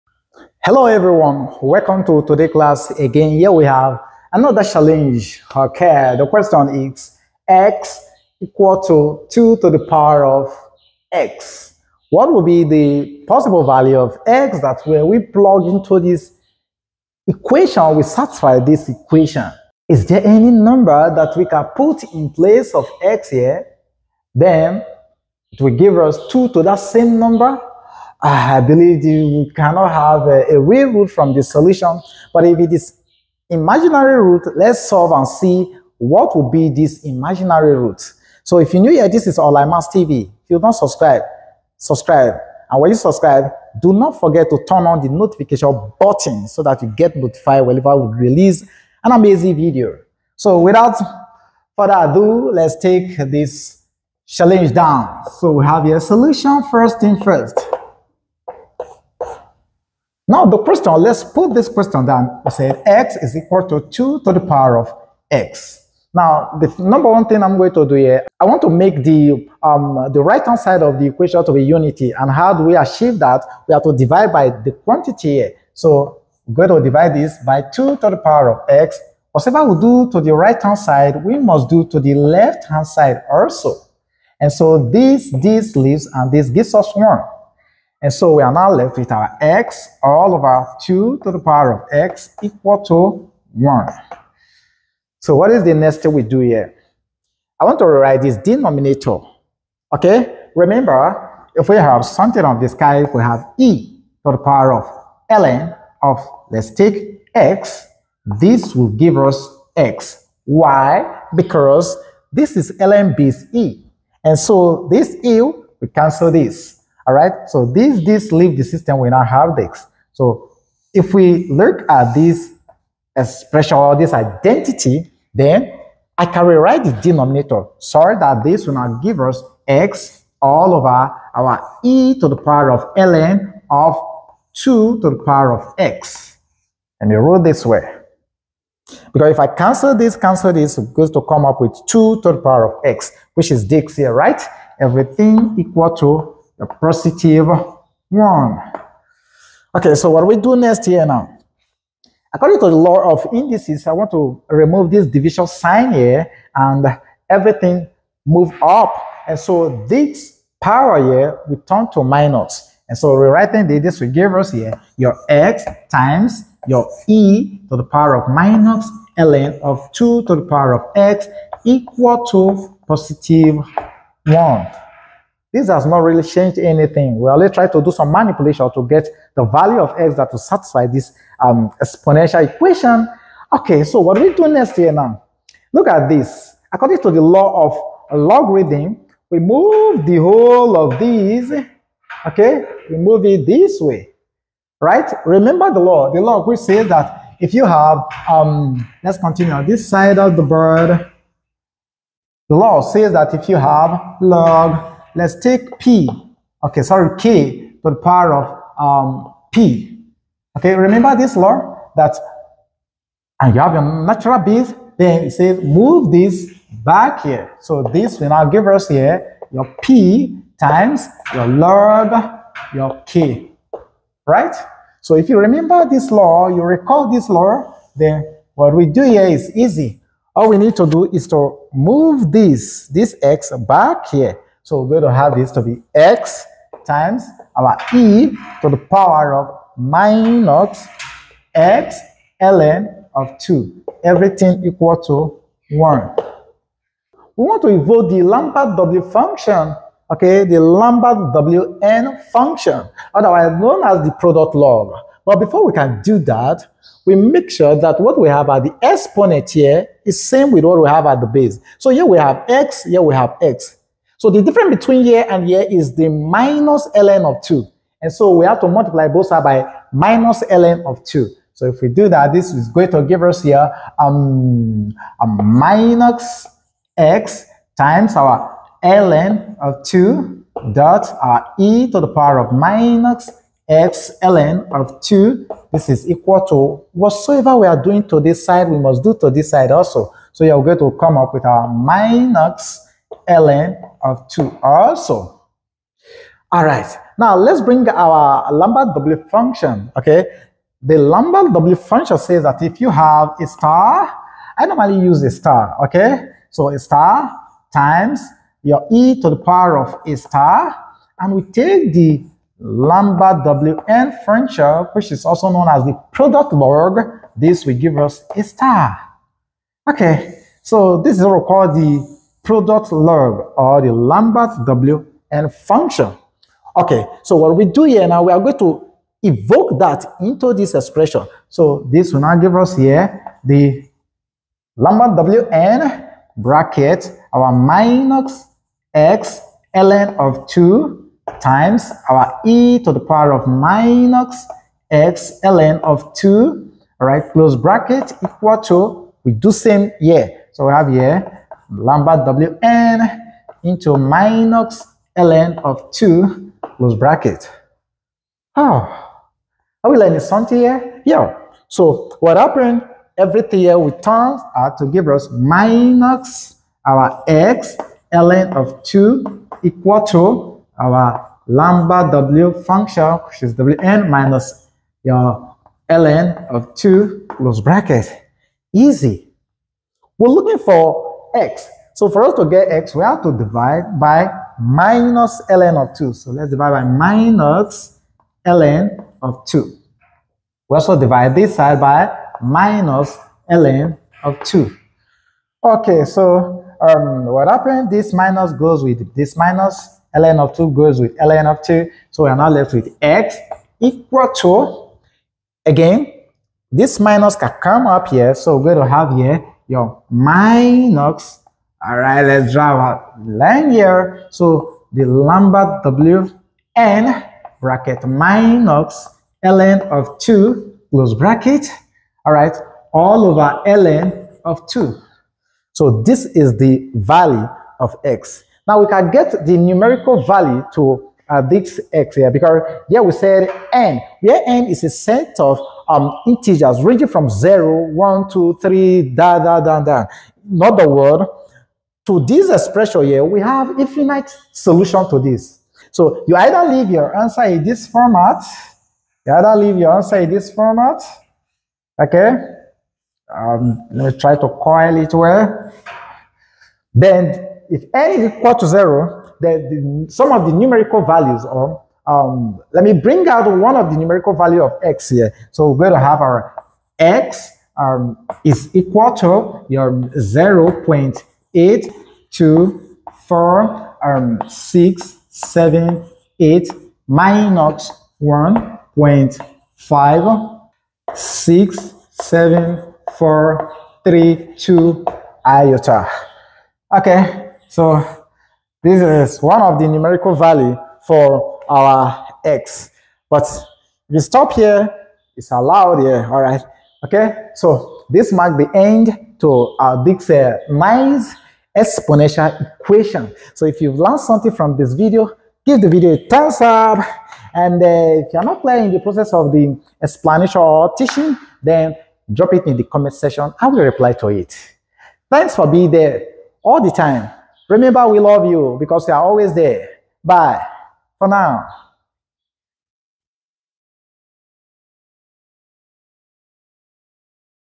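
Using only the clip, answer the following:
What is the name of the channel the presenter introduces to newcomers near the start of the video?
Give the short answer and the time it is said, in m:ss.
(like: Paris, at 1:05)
i must TV, at 0:39.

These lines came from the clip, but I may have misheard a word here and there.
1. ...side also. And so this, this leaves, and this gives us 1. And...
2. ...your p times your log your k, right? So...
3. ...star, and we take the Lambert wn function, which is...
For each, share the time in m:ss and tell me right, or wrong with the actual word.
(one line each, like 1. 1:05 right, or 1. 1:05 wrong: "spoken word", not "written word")
1. 1:22 right
2. 3:39 right
3. 5:10 right.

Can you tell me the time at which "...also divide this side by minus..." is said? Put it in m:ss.
6:30.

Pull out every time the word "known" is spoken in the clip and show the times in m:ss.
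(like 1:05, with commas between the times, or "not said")
4:13, 5:15.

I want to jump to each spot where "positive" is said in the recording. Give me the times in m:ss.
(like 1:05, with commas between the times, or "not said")
2:26, 2:52.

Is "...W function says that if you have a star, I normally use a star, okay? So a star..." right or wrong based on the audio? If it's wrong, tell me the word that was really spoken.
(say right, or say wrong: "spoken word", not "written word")
right.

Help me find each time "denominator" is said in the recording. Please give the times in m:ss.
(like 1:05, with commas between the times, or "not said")
1:38, 2:06.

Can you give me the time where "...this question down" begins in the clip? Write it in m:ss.
1:01.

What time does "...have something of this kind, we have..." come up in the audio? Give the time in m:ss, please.
1:41.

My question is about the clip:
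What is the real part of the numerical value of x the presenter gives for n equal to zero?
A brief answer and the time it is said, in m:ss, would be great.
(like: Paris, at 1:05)
0.824678, at 7:50.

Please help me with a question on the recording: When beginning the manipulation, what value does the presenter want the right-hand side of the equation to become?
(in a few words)
unity.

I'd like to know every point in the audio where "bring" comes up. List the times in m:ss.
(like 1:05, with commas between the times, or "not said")
4:57, 7:42.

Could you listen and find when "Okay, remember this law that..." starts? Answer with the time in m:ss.
3:30.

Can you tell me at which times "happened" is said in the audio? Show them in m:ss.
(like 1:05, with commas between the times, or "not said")
6:02, 6:37.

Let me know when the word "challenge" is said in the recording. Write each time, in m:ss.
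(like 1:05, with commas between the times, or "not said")
0:04, 0:54.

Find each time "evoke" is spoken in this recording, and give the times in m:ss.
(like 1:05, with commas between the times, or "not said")
4:07, 5:29.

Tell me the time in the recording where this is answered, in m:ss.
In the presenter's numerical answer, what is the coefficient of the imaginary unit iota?
7:57.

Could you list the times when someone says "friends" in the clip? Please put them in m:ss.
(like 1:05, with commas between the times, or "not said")
not said.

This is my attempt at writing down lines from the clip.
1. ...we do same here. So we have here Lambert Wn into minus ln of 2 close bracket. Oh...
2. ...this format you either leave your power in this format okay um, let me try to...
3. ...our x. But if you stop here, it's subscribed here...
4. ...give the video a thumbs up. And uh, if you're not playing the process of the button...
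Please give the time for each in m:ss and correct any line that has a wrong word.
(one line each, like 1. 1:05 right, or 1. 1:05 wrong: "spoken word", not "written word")
1. 5:49 right
2. 7:27 wrong: "answer", not "power"
3. 8:11 wrong: "allowed", not "subscribed"
4. 8:25 wrong: "explanation", not "button".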